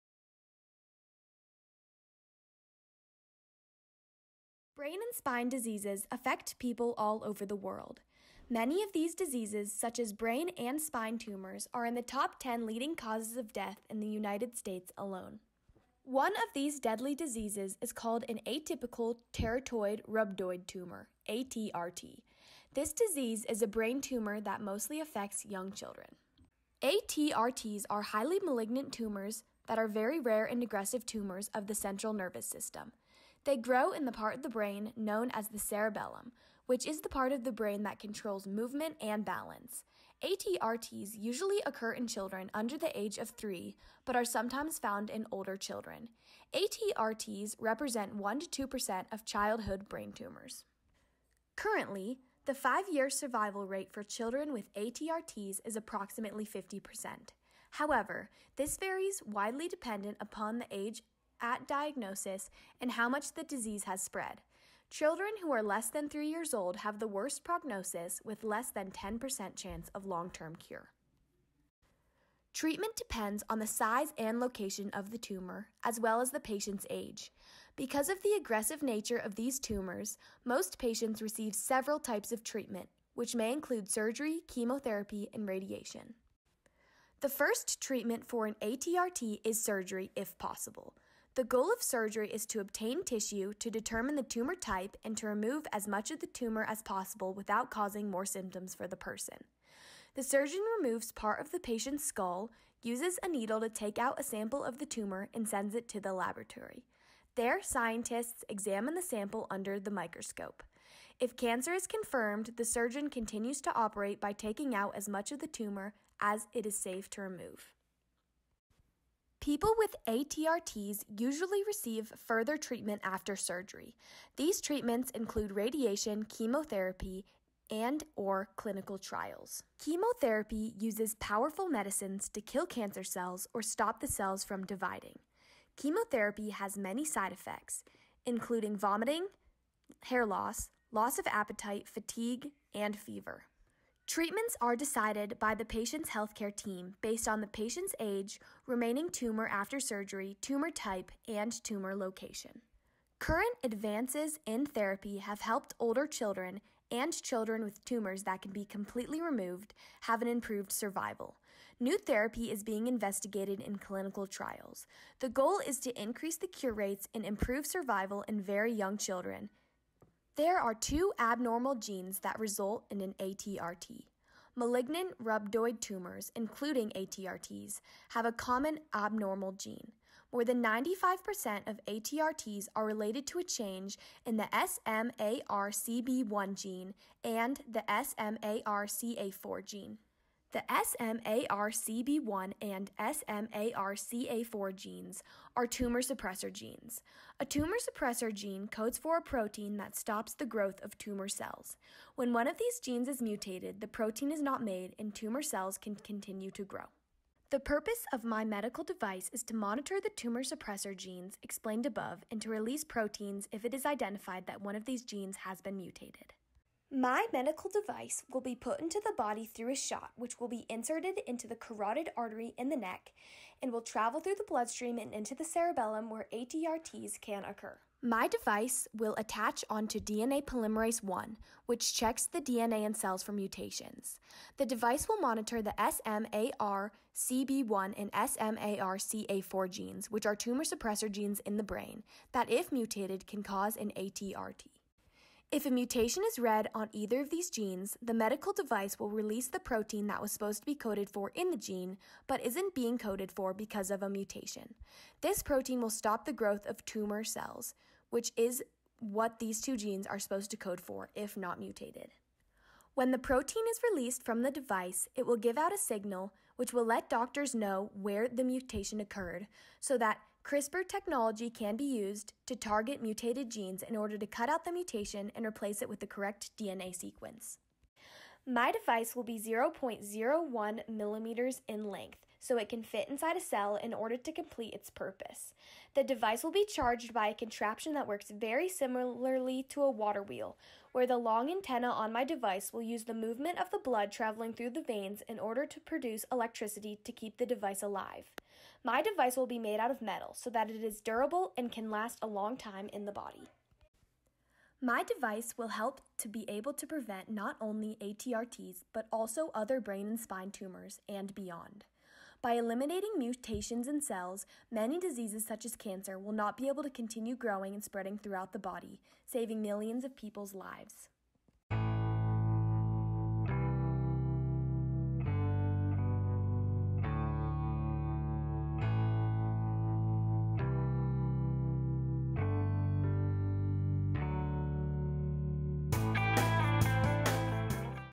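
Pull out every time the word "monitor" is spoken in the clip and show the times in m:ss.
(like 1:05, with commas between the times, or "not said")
3:29, 3:55.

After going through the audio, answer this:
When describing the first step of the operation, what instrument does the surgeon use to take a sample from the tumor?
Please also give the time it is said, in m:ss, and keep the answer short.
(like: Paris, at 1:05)
a needle, at 1:43.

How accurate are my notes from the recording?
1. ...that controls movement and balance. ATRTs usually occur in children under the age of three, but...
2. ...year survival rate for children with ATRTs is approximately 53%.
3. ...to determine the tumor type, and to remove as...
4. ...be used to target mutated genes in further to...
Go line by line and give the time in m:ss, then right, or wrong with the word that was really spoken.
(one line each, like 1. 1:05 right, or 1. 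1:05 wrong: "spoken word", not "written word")
1. 0:37 right
2. 0:52 wrong: "50", not "53"
3. 1:33 right
4. 4:31 wrong: "order", not "further".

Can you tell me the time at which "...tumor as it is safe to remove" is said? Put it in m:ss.
1:55.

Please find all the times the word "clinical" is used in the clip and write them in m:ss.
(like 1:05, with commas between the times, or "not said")
2:08, 2:43.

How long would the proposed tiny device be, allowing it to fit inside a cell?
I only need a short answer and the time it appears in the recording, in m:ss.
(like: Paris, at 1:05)
0.01 millimeters, at 4:39.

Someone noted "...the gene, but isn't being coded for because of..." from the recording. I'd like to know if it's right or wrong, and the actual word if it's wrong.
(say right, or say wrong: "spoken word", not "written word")
right.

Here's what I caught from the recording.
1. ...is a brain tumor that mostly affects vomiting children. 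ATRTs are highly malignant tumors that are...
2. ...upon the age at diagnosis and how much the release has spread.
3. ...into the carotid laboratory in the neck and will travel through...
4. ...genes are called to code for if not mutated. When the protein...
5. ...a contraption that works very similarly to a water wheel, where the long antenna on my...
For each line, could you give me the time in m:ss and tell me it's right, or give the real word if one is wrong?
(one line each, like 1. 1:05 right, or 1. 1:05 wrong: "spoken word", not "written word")
1. 0:23 wrong: "young", not "vomiting"
2. 1:00 wrong: "disease", not "release"
3. 3:41 wrong: "artery", not "laboratory"
4. 4:19 wrong: "supposed", not "called"
5. 4:47 right.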